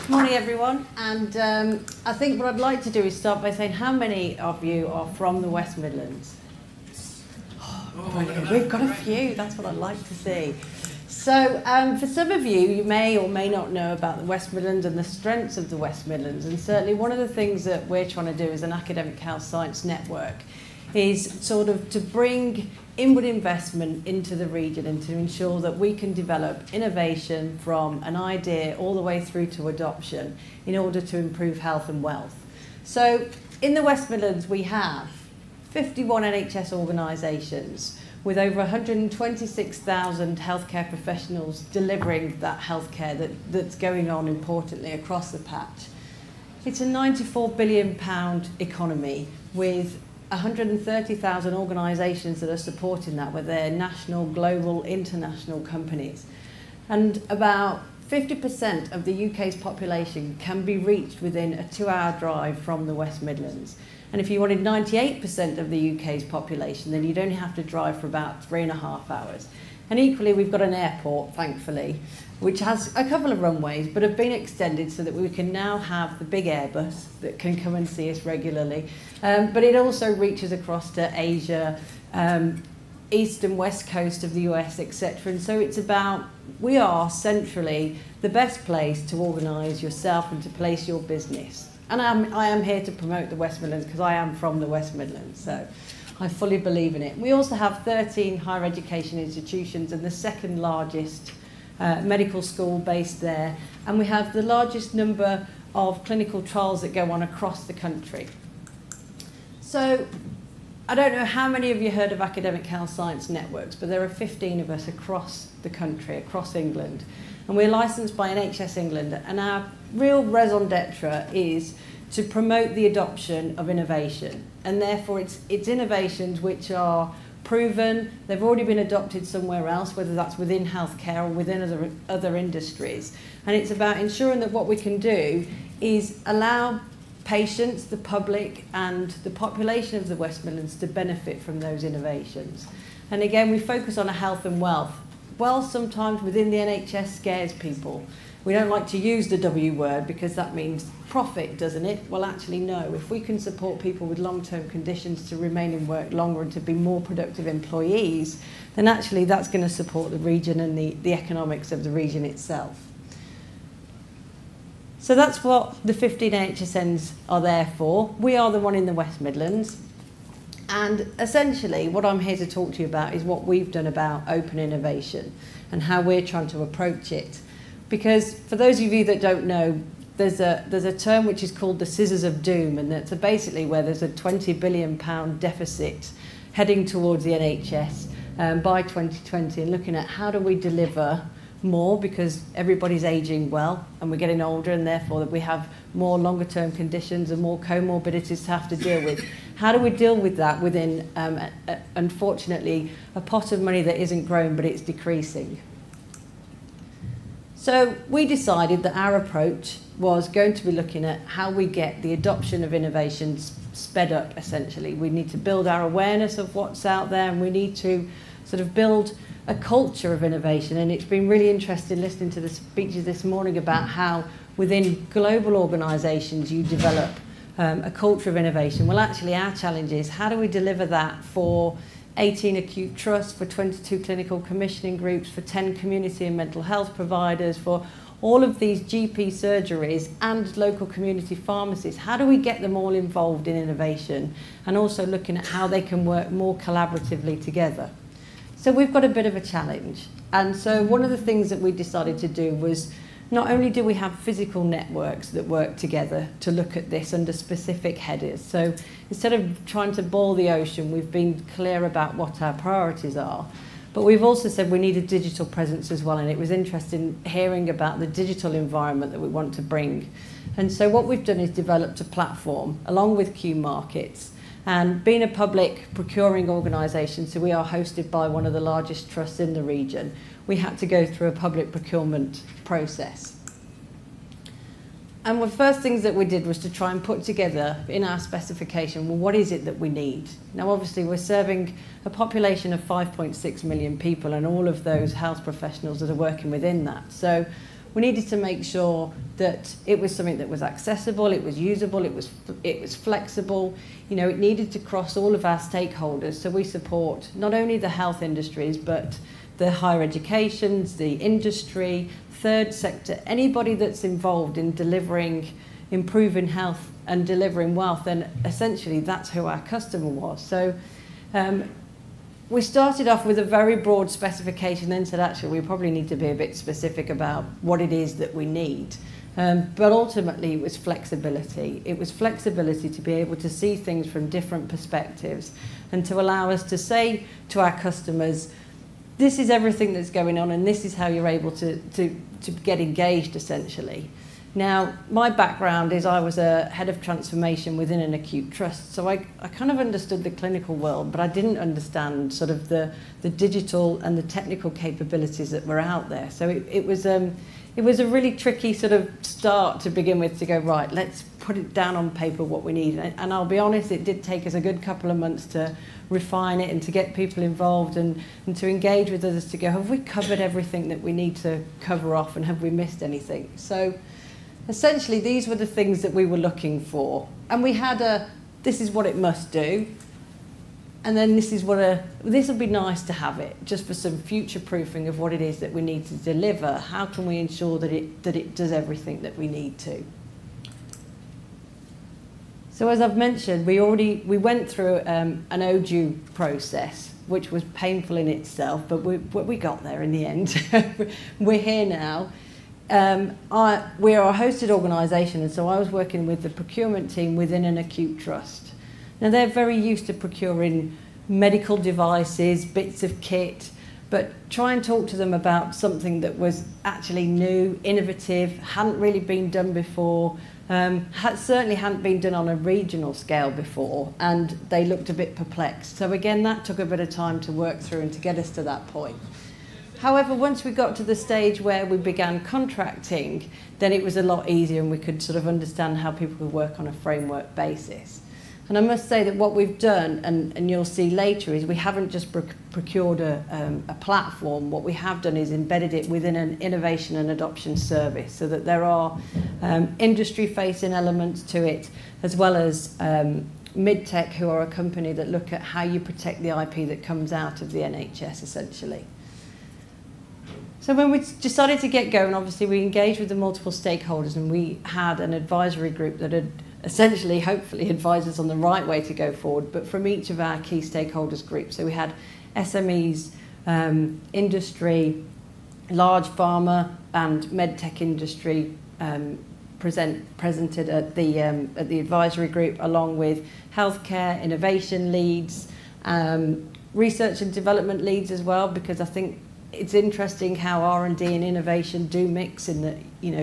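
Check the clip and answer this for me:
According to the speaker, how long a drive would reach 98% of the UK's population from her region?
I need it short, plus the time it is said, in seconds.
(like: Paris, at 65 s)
3.5 hours, at 68 s.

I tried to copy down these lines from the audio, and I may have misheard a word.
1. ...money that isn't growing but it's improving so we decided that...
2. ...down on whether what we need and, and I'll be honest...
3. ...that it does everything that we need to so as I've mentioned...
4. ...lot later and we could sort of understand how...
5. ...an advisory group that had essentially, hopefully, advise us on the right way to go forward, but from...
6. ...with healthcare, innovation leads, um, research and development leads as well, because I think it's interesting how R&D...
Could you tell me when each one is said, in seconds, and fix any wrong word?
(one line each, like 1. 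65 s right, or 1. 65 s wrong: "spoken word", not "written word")
1. 203 s wrong: "decreasing", not "improving"
2. 361 s wrong: "paper", not "whether"
3. 388 s right
4. 434 s wrong: "easier", not "later"
5. 465 s right
6. 483 s right.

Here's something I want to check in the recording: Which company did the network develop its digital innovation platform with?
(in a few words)
Qmarkets.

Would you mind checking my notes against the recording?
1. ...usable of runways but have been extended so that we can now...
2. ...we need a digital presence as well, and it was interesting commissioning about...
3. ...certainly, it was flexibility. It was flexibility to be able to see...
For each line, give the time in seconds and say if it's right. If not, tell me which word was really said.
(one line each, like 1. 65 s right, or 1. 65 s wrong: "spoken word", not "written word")
1. 73 s wrong: "couple", not "usable"
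2. 264 s wrong: "hearing", not "commissioning"
3. 329 s wrong: "ultimately", not "certainly".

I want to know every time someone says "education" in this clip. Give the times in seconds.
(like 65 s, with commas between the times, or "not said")
98 s, 310 s.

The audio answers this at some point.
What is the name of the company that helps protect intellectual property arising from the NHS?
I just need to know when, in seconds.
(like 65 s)
453 s.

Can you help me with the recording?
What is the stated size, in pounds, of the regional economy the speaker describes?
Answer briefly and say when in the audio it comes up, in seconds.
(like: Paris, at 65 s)
94 billion pounds, at 46 s.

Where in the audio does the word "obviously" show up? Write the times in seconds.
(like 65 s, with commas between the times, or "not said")
290 s, 462 s.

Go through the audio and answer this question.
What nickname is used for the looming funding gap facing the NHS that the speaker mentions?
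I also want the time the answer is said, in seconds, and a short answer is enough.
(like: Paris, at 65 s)
the scissors of doom, at 181 s.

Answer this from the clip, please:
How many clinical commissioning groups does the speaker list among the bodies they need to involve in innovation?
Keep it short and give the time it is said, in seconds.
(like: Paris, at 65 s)
22, at 233 s.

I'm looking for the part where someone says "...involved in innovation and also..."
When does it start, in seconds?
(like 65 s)
242 s.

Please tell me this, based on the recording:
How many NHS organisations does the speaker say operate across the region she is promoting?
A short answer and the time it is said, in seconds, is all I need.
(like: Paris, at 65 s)
51, at 35 s.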